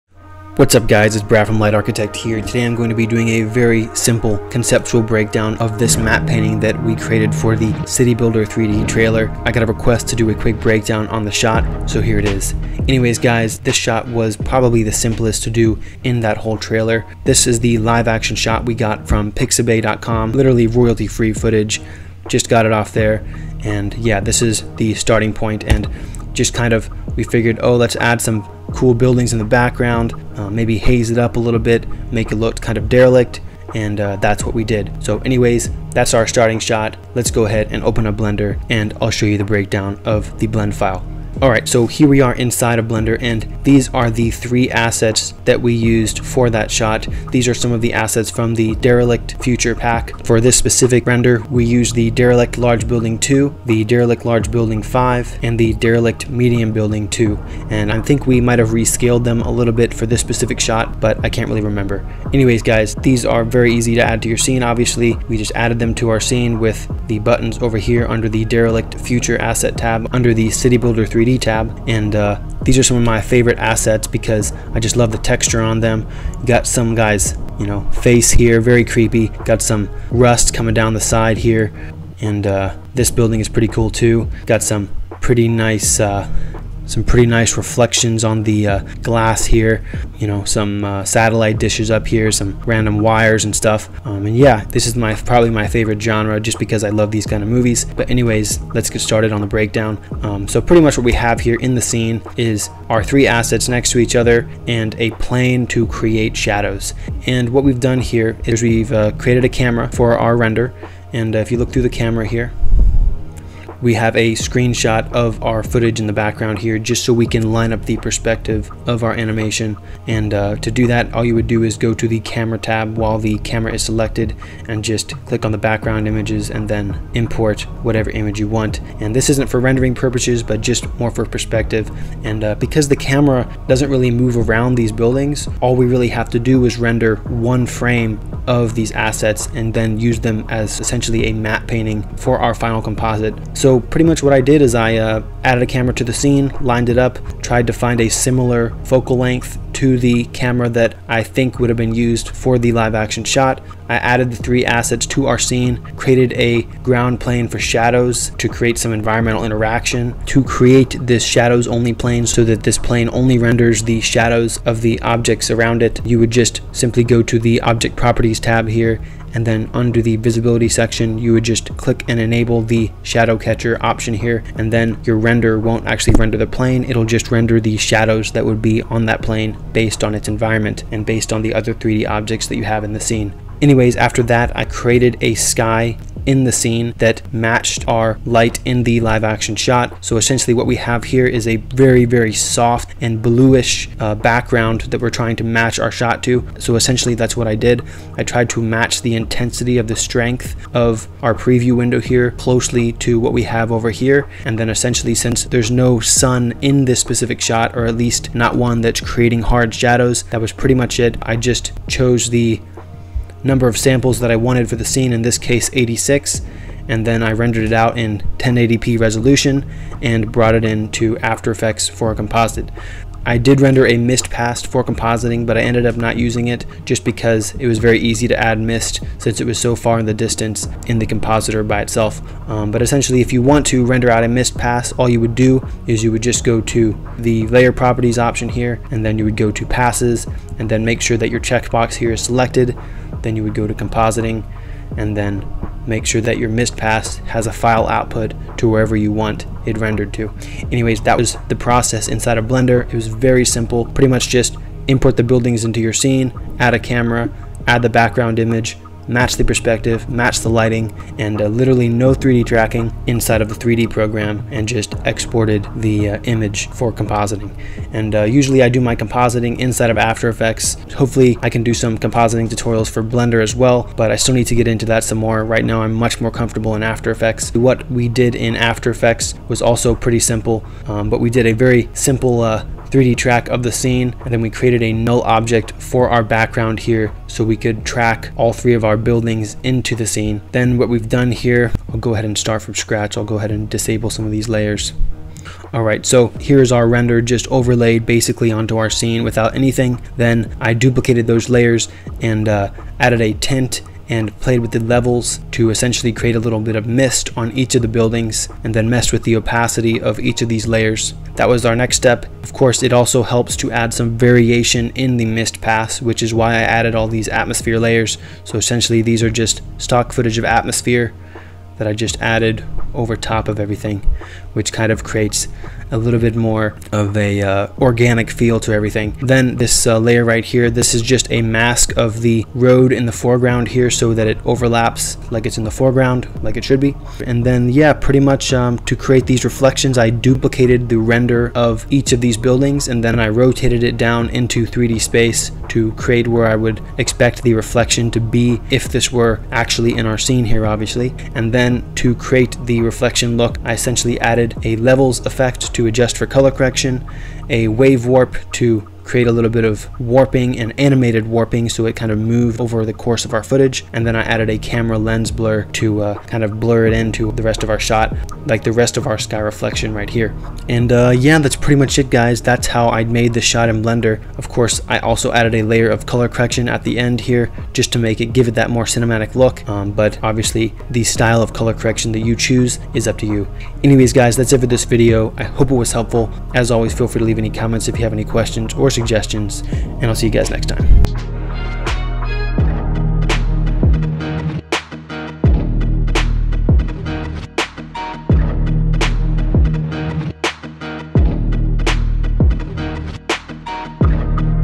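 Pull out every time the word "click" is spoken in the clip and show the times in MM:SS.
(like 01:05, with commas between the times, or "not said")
02:05, 02:51.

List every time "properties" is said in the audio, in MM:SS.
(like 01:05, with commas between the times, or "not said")
02:47, 03:57.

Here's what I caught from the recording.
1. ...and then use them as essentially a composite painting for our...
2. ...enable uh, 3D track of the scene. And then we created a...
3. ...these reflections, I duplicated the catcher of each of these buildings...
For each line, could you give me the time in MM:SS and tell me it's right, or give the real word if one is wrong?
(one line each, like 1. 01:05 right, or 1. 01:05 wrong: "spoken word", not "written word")
1. 02:19 wrong: "matte", not "composite"
2. 04:41 wrong: "simple", not "enable"
3. 05:39 wrong: "render", not "catcher".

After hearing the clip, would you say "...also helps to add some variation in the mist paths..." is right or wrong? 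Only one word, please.
right.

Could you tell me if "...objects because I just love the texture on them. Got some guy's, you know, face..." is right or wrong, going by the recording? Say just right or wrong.
wrong.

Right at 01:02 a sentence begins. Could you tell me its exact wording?
Anyways guys, these are very easy to add to your scene.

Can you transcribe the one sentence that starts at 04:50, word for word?
Then what we've done here, I'll go ahead and start from scratch.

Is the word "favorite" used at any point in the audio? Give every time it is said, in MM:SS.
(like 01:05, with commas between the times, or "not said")
01:13, 01:35.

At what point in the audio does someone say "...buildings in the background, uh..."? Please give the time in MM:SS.
00:28.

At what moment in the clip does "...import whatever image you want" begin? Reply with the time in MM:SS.
02:07.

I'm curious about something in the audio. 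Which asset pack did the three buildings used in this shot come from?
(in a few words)
Derelict Future Pack.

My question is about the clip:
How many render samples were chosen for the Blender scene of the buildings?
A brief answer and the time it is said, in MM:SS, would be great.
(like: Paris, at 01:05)
86, at 03:35.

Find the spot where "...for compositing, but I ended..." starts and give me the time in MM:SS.
03:44.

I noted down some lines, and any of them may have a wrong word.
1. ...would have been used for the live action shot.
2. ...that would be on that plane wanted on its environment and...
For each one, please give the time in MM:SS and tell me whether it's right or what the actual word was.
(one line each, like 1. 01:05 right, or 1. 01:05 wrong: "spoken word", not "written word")
1. 02:31 right
2. 02:58 wrong: "based", not "wanted".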